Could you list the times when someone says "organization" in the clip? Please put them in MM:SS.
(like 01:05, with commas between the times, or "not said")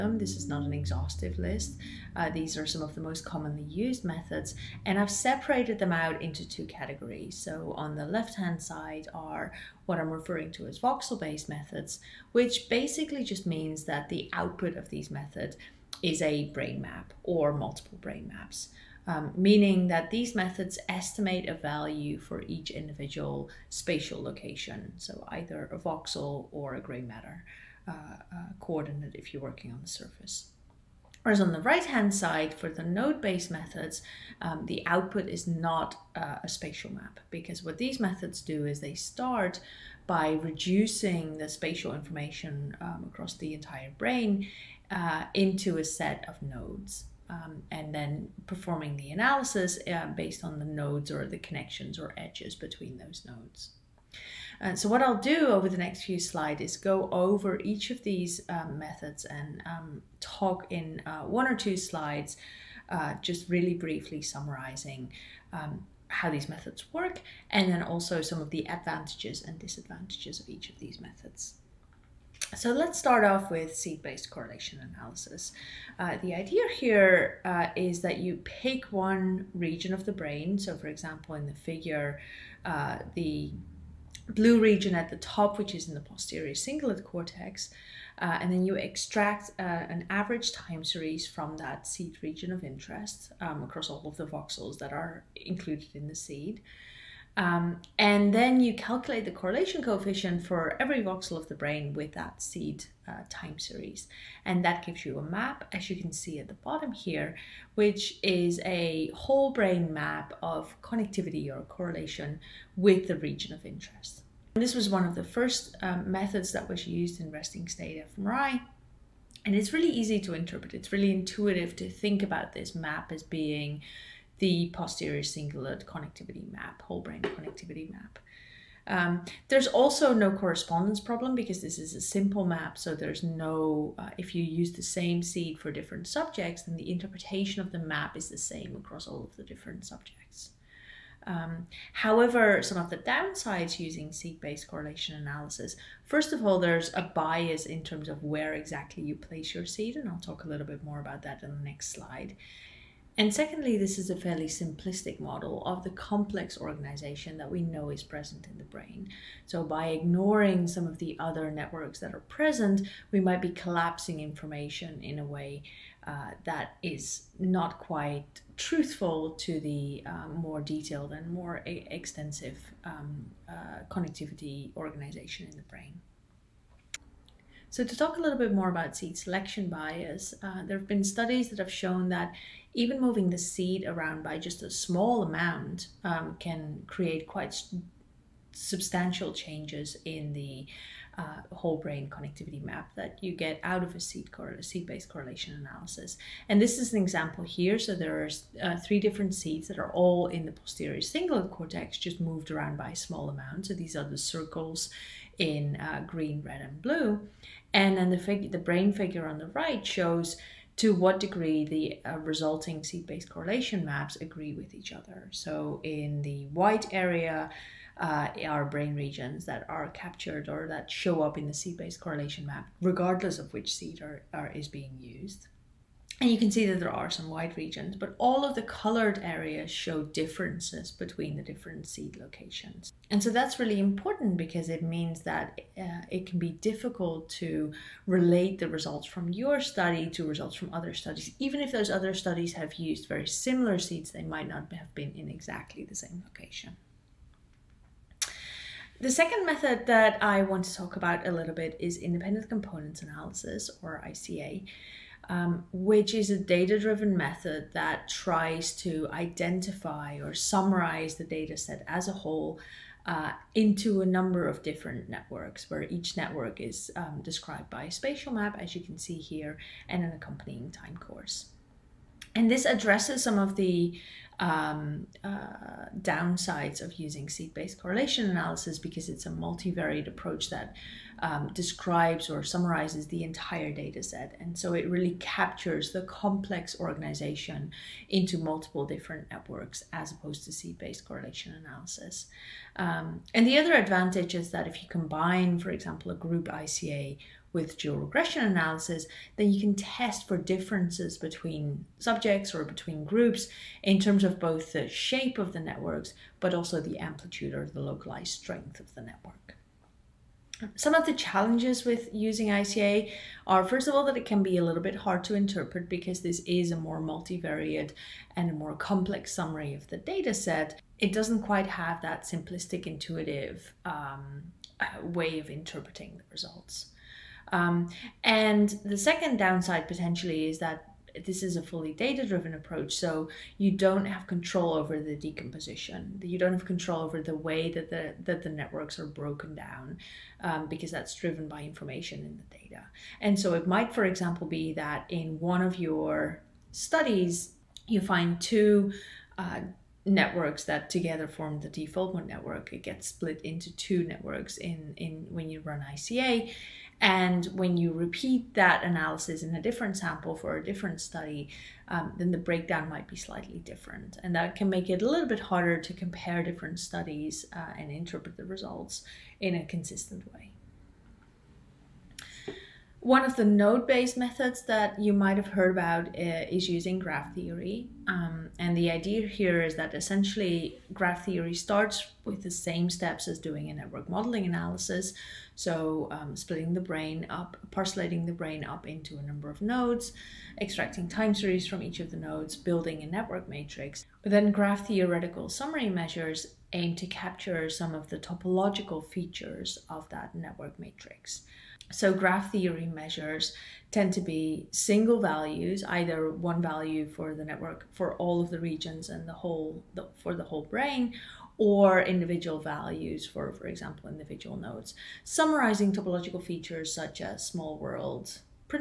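02:36, 02:54, 04:46.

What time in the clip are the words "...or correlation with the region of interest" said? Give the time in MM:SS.
01:51.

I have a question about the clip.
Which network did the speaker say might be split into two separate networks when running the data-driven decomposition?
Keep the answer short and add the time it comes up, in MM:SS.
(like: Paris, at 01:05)
default network, at 05:51.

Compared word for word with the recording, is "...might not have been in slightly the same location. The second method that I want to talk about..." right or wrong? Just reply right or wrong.
wrong.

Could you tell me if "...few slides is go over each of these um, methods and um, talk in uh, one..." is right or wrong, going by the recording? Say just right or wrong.
right.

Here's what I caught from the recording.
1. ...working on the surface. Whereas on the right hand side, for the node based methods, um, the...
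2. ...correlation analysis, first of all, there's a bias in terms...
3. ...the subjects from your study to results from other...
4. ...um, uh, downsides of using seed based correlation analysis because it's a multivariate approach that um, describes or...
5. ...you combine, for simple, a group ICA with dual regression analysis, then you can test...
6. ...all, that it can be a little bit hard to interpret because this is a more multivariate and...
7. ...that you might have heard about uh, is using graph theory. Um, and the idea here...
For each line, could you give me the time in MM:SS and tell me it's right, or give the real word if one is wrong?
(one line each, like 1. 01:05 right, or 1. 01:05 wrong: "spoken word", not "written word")
1. 00:29 right
2. 02:24 right
3. 03:58 wrong: "results", not "subjects"
4. 04:34 right
5. 04:54 wrong: "example", not "simple"
6. 05:13 right
7. 06:14 right.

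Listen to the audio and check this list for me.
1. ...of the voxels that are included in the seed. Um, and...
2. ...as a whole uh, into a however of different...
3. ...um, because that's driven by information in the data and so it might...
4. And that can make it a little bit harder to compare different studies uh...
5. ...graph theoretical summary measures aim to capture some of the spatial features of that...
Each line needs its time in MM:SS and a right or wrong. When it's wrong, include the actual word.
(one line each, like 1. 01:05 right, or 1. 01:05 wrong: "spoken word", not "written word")
1. 01:34 right
2. 04:21 wrong: "number", not "however"
3. 05:40 right
4. 06:04 right
5. 06:34 wrong: "topological", not "spatial".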